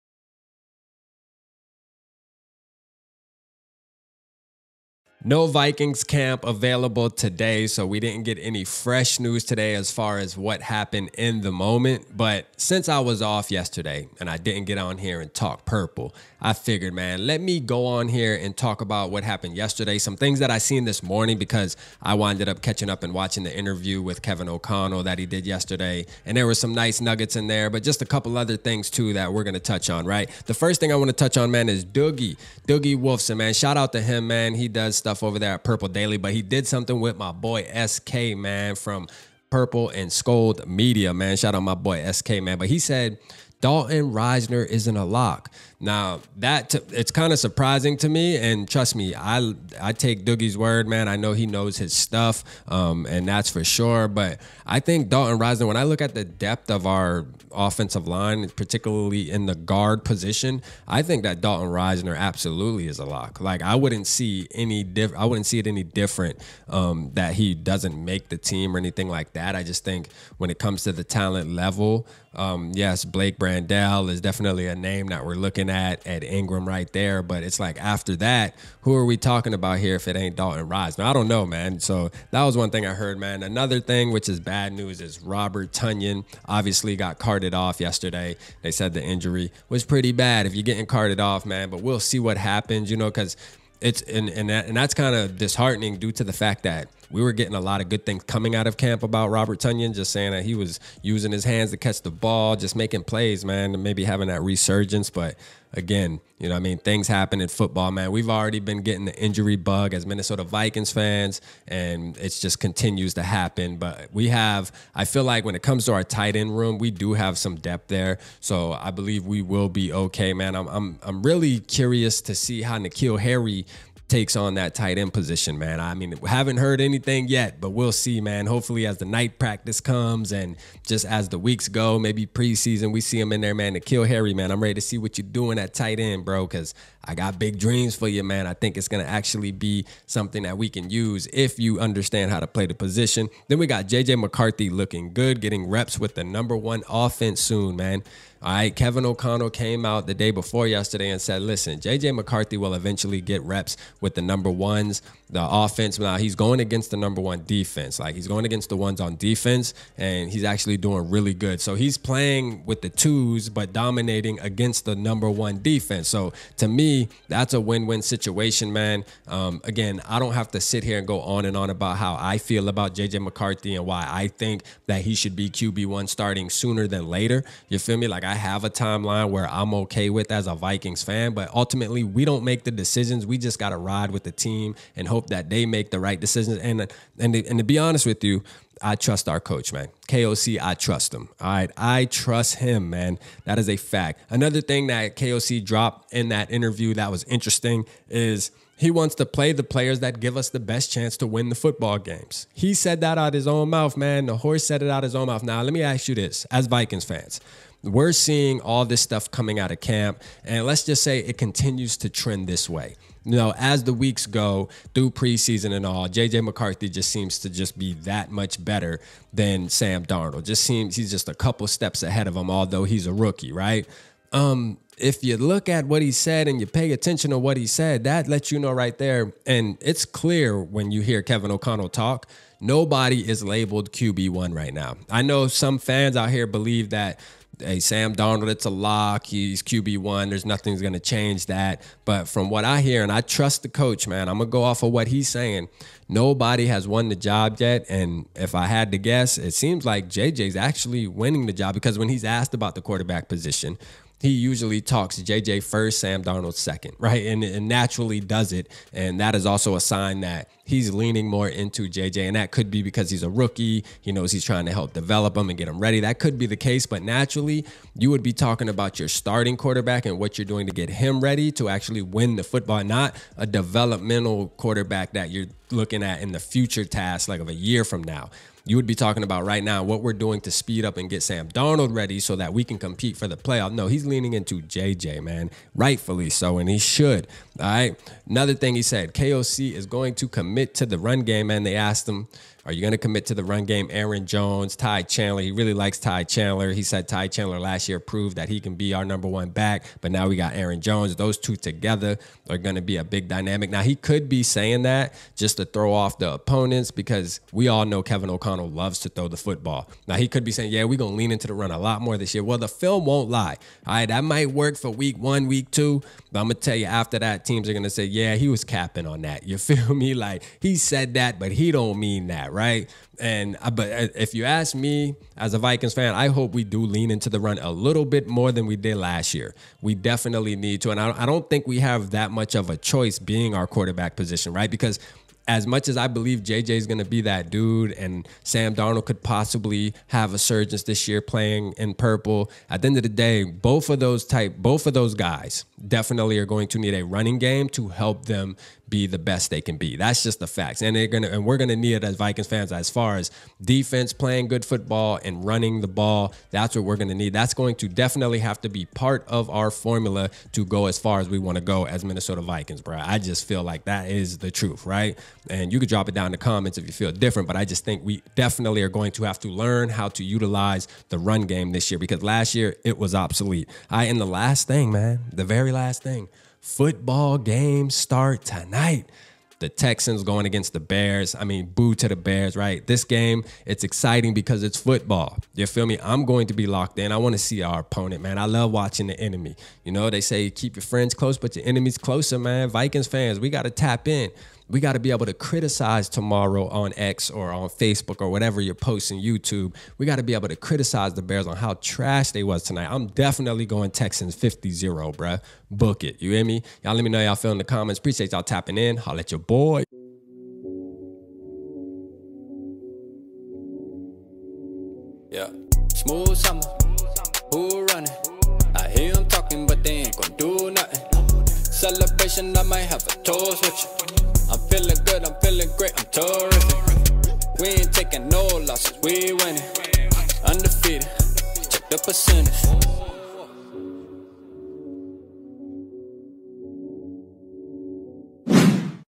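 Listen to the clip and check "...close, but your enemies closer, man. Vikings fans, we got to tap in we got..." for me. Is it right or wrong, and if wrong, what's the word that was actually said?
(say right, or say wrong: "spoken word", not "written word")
right.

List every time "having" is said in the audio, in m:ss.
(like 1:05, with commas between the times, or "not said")
1:44.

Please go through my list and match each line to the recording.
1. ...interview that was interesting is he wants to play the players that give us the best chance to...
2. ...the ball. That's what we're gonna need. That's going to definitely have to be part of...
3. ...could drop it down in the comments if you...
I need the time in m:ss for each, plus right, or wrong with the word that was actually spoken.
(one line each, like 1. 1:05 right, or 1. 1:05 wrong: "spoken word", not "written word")
1. 3:16 right
2. 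5:55 right
3. 6:05 right.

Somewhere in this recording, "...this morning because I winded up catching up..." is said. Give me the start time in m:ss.
0:20.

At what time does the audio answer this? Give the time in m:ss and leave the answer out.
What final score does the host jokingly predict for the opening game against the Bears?
6:44.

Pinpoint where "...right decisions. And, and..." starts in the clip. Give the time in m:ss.
3:05.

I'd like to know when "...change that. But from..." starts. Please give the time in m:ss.
4:00.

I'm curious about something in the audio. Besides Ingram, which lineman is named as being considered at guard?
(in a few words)
Blake Brandel.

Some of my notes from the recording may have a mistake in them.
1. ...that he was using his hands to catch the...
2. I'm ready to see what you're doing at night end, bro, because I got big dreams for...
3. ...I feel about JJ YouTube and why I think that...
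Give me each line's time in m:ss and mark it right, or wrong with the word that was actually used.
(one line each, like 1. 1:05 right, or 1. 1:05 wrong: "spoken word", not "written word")
1. 1:40 right
2. 2:14 wrong: "tight", not "night"
3. 2:52 wrong: "McCarthy", not "YouTube".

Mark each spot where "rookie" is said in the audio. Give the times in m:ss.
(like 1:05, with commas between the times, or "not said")
3:43, 4:23.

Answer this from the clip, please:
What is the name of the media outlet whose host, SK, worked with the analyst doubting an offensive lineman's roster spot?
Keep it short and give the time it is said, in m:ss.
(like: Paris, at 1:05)
Purple and Skol Media, at 0:39.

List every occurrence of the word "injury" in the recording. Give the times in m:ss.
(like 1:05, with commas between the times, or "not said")
1:29, 1:49.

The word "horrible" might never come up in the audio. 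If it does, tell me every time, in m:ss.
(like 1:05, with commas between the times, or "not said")
not said.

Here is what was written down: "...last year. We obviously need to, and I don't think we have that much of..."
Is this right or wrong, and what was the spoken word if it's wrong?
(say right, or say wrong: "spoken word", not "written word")
wrong: "definitely", not "obviously".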